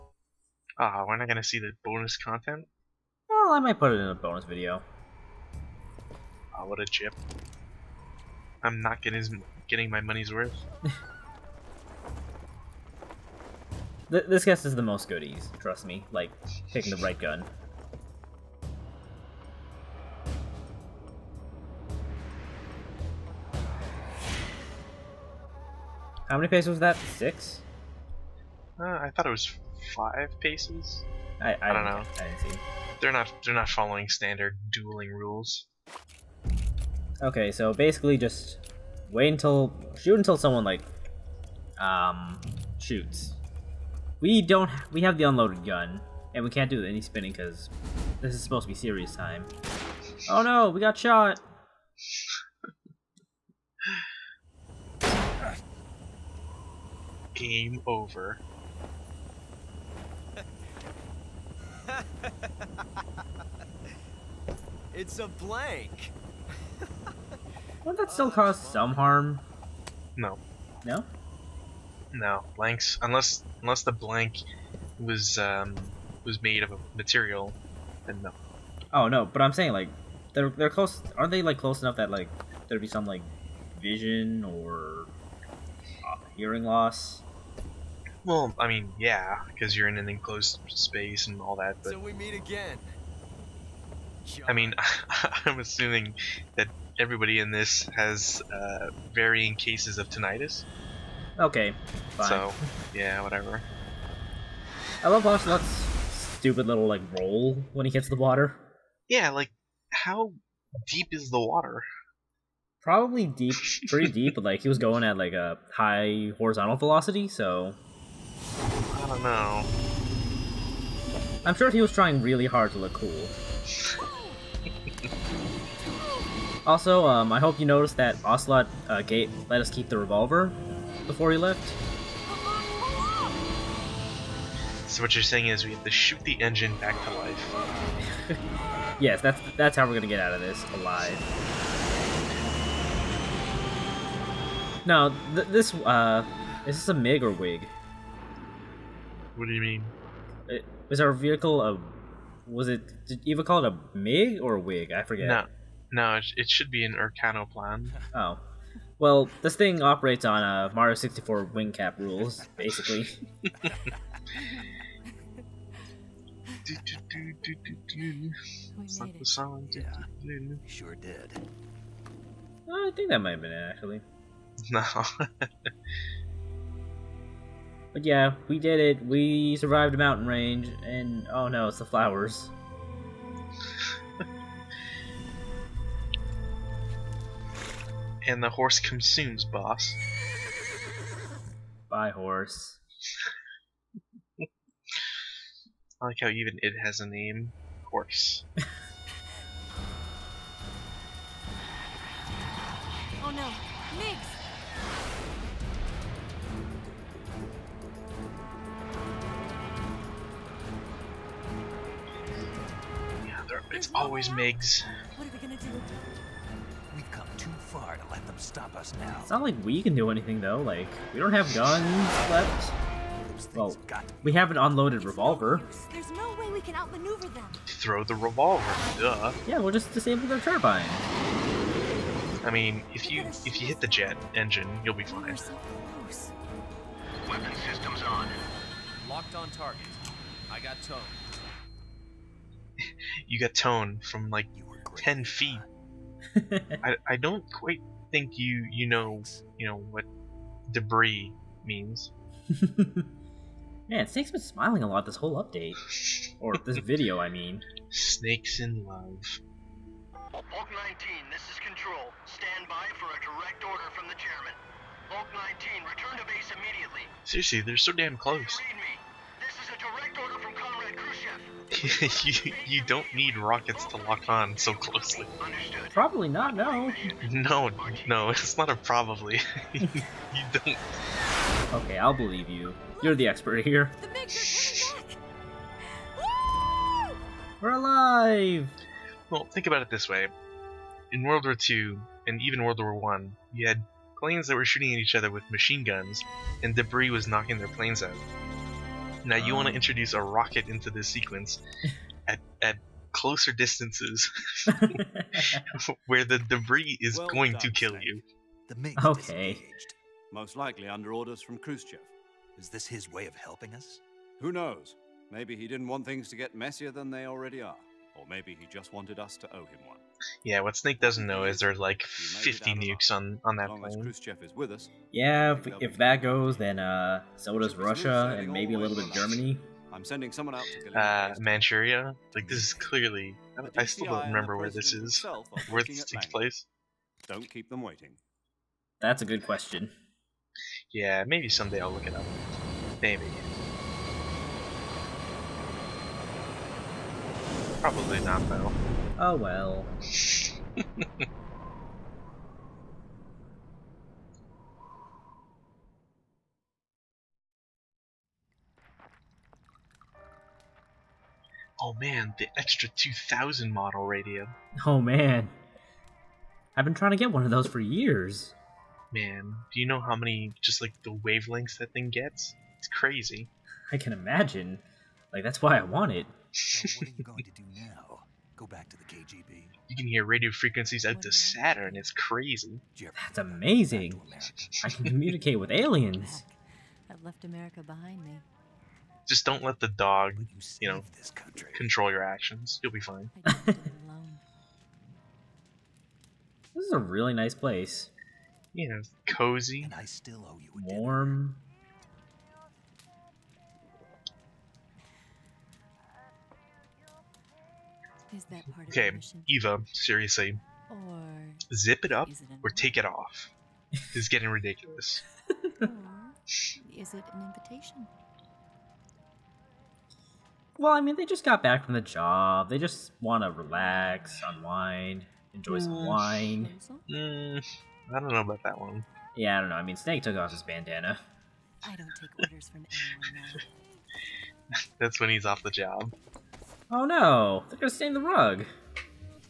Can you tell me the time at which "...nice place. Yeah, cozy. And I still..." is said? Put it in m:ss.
6:37.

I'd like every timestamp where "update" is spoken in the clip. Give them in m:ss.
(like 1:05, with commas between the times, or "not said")
4:15.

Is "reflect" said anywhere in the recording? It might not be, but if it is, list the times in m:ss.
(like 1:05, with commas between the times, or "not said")
not said.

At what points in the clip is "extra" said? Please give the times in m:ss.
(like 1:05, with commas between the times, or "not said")
6:02.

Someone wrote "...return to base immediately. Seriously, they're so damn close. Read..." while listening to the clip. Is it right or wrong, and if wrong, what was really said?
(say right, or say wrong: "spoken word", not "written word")
right.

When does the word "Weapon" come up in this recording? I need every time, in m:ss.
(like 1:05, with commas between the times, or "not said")
3:57.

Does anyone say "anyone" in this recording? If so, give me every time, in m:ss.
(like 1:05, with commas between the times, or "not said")
7:13.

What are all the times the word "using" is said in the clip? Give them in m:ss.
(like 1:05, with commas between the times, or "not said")
not said.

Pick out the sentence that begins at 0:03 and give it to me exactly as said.
Well, I might put it in a bonus video.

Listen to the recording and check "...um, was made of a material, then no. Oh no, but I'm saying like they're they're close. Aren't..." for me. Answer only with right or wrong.
right.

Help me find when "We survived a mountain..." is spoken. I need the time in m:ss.
2:59.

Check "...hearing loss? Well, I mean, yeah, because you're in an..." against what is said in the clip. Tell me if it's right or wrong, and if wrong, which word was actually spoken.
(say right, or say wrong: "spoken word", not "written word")
right.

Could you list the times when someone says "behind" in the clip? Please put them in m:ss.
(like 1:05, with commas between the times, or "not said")
6:27.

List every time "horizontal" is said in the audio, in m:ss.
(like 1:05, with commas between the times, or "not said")
1:56.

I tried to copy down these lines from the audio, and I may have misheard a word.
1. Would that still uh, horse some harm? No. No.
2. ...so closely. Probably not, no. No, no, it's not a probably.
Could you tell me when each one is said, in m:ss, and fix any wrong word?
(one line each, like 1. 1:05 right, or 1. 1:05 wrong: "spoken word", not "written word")
1. 1:07 wrong: "cause", not "horse"
2. 4:34 right.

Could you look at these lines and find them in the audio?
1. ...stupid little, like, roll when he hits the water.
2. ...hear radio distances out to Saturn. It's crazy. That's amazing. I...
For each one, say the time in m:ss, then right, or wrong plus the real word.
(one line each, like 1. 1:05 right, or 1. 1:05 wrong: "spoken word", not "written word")
1. 1:46 right
2. 6:20 wrong: "frequencies", not "distances".